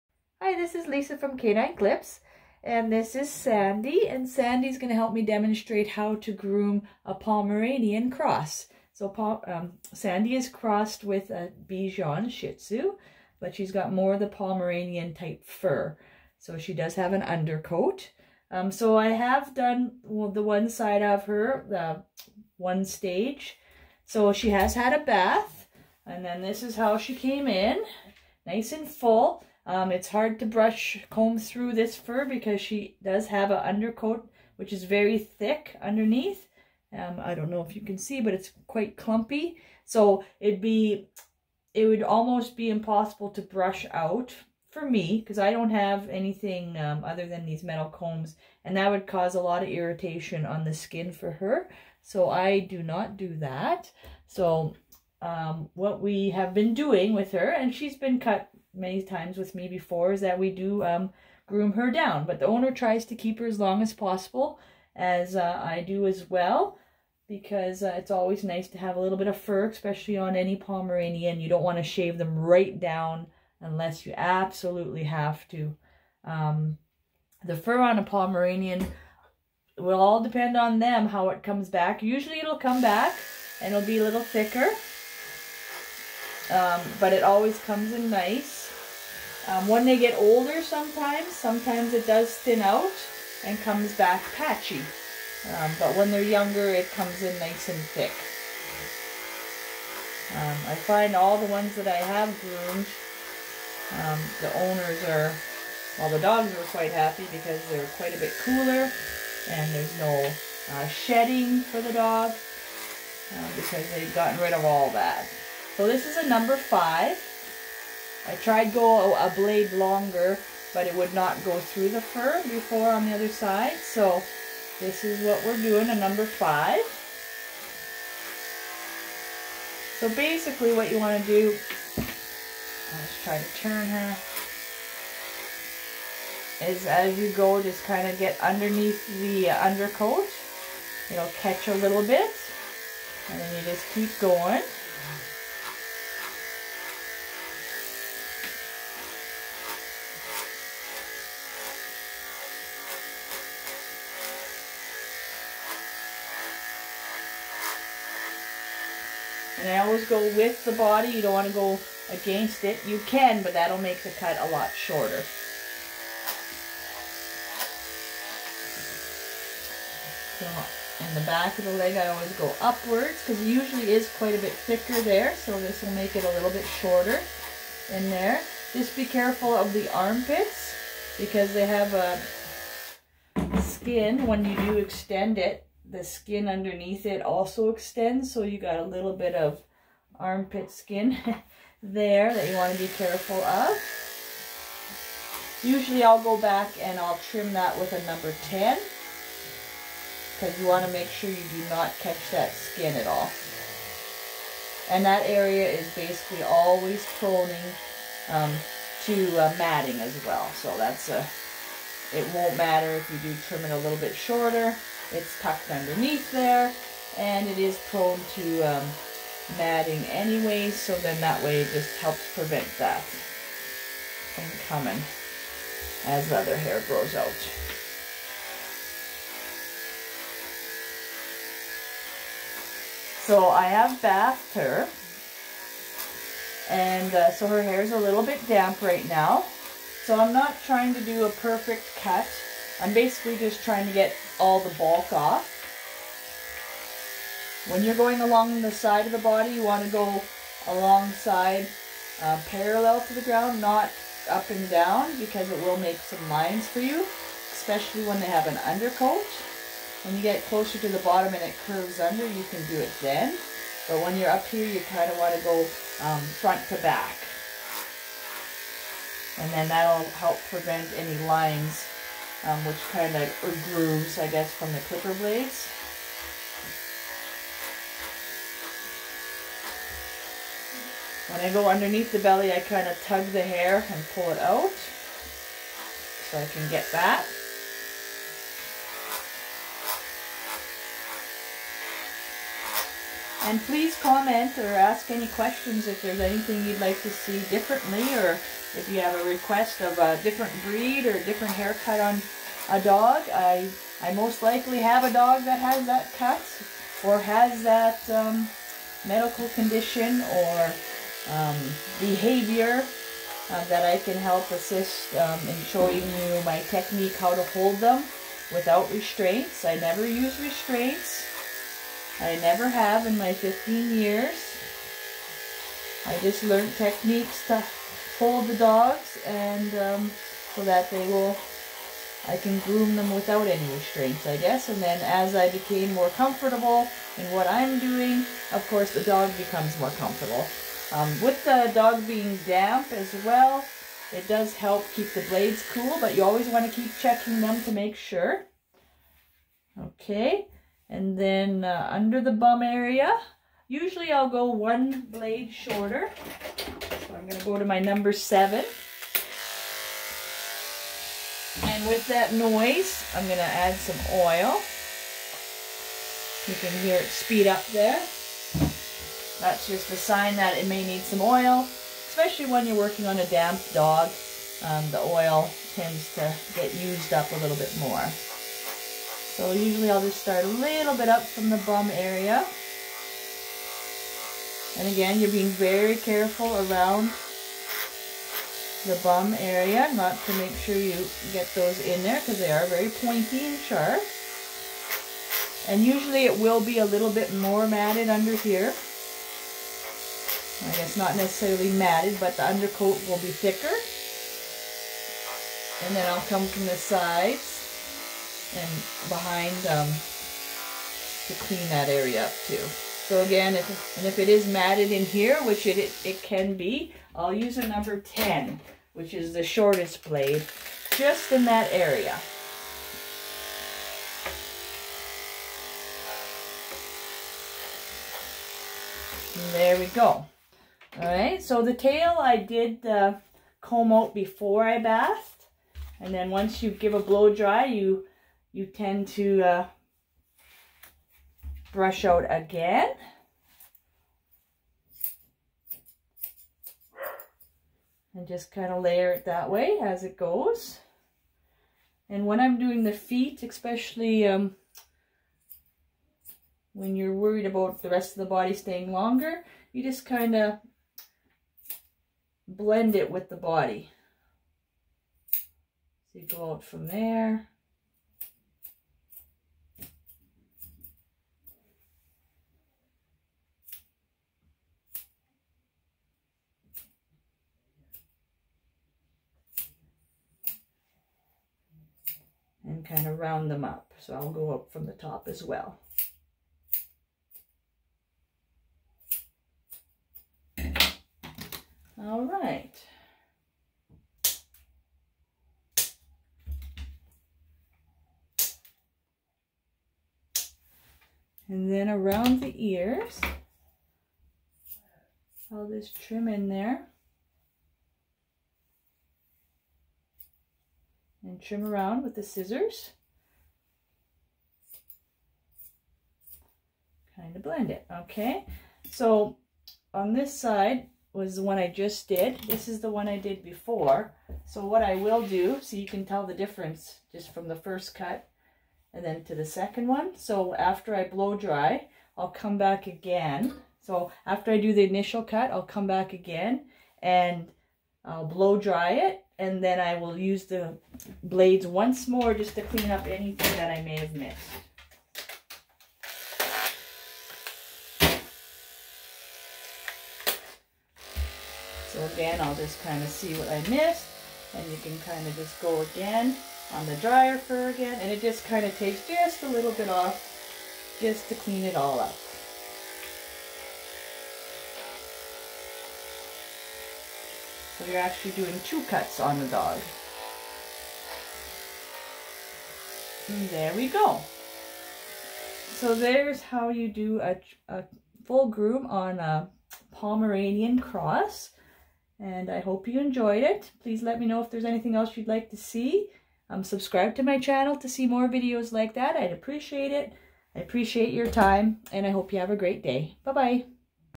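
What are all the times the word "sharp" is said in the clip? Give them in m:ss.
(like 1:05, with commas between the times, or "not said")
6:33.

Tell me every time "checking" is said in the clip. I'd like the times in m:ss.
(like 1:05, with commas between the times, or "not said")
5:46.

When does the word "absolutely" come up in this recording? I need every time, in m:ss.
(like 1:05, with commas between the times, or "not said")
1:14.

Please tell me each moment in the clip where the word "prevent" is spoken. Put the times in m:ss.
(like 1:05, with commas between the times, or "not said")
3:42, 4:30.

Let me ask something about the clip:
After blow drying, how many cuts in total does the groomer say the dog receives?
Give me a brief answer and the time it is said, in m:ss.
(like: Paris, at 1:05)
2, at 9:28.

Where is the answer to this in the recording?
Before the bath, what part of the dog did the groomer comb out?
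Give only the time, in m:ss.
7:11.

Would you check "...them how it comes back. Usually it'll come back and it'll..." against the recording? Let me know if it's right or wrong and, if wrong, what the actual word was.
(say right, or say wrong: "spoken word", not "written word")
right.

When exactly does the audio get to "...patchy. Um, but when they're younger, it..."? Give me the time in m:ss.
1:34.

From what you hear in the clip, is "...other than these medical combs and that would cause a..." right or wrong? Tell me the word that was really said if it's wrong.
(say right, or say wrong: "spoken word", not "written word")
wrong: "metal", not "medical".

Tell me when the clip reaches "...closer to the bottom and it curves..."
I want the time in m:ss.
4:20.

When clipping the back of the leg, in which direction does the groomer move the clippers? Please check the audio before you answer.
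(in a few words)
Upwards.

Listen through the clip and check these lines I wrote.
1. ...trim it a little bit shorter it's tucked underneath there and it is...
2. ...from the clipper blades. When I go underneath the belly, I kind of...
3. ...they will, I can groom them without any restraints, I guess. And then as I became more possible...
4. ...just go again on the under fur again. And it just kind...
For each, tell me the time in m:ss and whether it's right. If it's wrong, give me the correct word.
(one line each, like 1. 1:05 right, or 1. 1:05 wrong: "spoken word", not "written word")
1. 3:33 right
2. 4:34 right
3. 5:30 wrong: "comfortable", not "possible"
4. 9:15 wrong: "dryer", not "under".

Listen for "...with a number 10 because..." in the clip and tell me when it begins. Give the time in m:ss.
3:17.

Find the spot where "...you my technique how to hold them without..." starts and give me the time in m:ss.
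5:15.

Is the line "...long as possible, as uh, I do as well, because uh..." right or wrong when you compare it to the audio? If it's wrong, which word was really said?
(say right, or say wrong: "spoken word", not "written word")
right.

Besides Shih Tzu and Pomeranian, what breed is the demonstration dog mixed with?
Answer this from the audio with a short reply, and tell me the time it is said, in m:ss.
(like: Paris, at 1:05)
Bichon, at 0:11.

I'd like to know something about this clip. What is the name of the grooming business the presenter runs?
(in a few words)
K9 Clipz.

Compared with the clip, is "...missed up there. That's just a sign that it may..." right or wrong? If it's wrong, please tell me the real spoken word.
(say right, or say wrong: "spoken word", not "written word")
wrong: "speed", not "missed".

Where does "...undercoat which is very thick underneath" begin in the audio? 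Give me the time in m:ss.
0:33.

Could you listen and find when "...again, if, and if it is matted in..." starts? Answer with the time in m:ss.
6:53.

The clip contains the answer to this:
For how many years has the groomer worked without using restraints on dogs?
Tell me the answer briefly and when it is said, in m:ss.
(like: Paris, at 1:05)
15, at 5:23.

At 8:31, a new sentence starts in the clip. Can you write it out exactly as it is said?
And trim around with the scissors.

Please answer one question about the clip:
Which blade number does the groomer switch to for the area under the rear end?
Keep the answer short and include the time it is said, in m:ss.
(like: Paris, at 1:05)
7, at 5:57.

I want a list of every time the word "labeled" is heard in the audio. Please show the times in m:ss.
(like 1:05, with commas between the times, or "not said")
not said.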